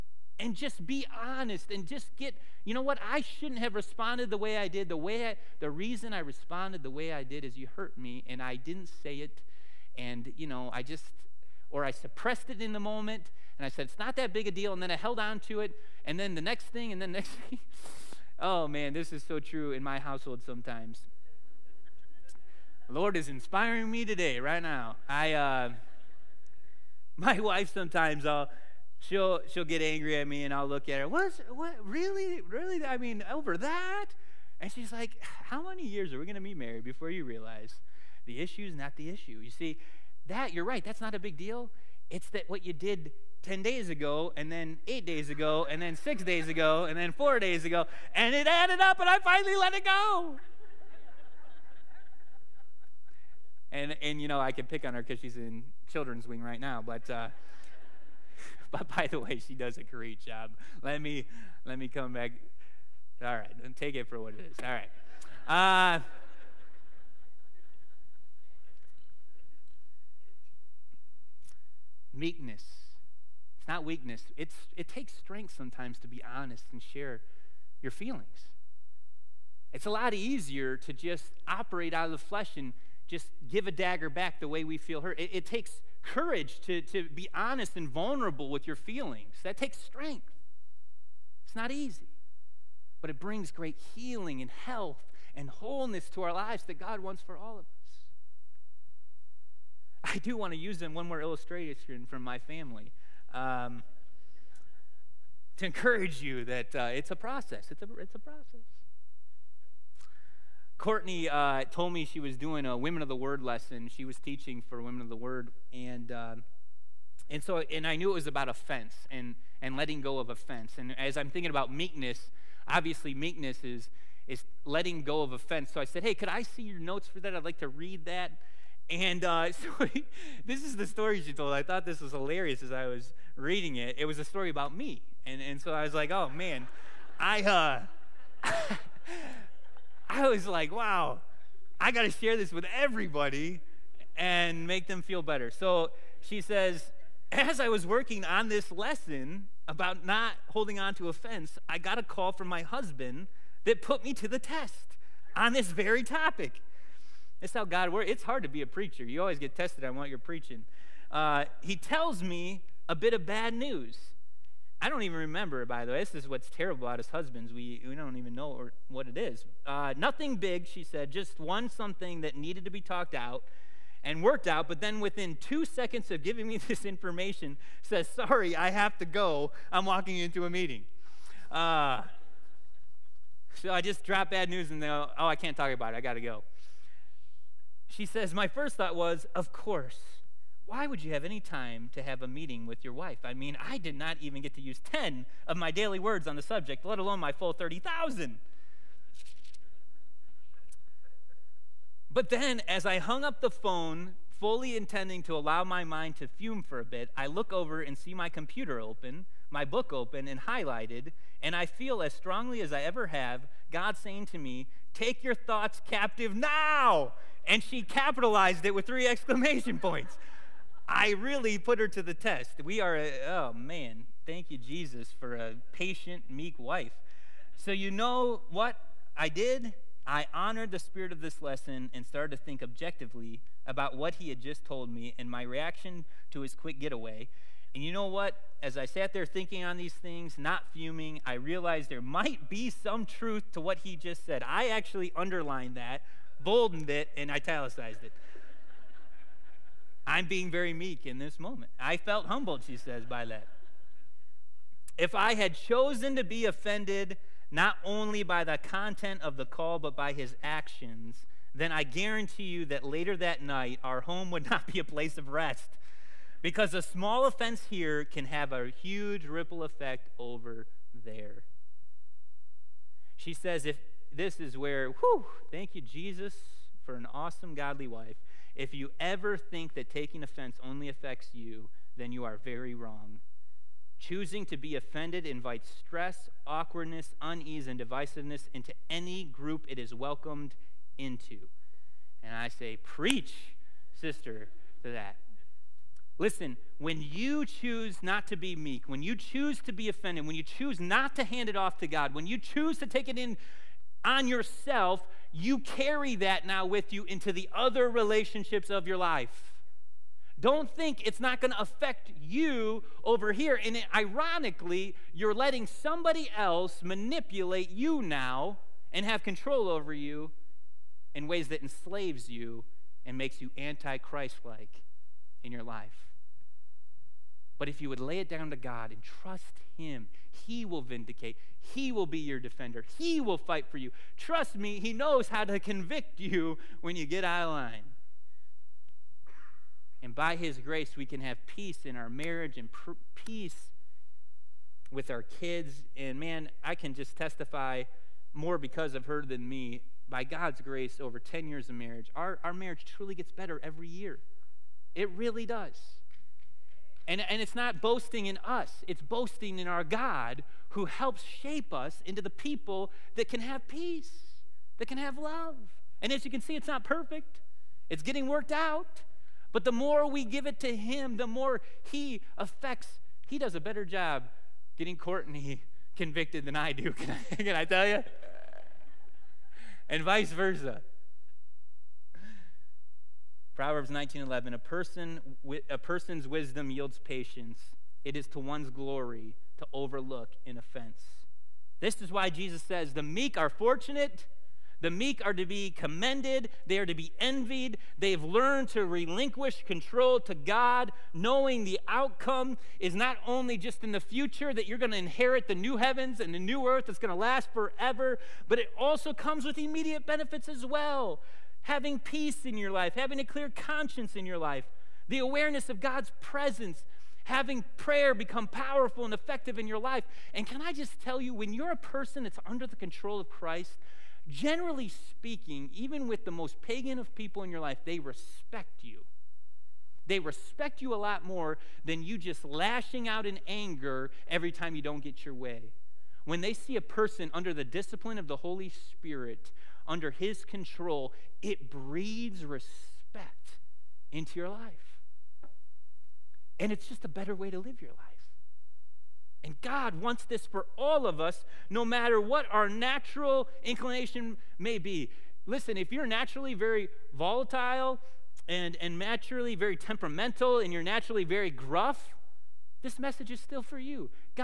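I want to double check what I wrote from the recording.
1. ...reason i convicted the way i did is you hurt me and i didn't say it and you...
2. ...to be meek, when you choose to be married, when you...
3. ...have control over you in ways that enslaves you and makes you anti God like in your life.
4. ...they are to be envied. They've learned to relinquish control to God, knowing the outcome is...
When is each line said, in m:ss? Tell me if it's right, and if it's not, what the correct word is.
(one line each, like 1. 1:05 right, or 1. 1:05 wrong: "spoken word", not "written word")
1. 0:05 wrong: "responded", not "convicted"
2. 4:58 wrong: "offended", not "married"
3. 5:19 wrong: "Christ", not "God"
4. 6:36 right.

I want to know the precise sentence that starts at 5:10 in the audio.
Don't think it's not going to affect you over here.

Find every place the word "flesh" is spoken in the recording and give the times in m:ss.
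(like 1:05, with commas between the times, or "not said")
1:22.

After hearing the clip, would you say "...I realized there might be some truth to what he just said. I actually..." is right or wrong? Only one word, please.
right.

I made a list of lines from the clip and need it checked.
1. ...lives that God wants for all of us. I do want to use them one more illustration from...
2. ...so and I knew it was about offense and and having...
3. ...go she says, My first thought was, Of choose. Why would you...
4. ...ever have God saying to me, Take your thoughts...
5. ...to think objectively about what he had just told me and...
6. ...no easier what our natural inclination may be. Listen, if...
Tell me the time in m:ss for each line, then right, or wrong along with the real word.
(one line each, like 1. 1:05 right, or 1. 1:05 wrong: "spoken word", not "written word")
1. 1:36 right
2. 1:57 wrong: "letting", not "having"
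3. 3:06 wrong: "course", not "choose"
4. 3:32 right
5. 3:52 right
6. 7:31 wrong: "matter", not "easier".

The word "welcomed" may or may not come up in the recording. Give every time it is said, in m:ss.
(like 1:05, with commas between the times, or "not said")
4:49.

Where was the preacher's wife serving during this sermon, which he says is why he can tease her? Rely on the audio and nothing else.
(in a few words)
children's wing.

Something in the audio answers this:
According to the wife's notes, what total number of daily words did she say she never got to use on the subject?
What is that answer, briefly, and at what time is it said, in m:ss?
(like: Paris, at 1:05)
30,000, at 3:17.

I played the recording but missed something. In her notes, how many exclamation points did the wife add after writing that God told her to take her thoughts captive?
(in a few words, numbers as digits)
3.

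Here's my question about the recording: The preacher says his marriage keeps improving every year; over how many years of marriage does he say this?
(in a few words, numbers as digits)
10 years.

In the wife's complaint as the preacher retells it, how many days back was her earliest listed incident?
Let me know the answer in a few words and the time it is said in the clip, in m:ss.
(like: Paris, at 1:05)
10 days, at 0:43.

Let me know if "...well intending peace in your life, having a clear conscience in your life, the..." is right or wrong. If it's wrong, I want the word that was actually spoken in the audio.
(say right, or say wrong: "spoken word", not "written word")
wrong: "having", not "intending".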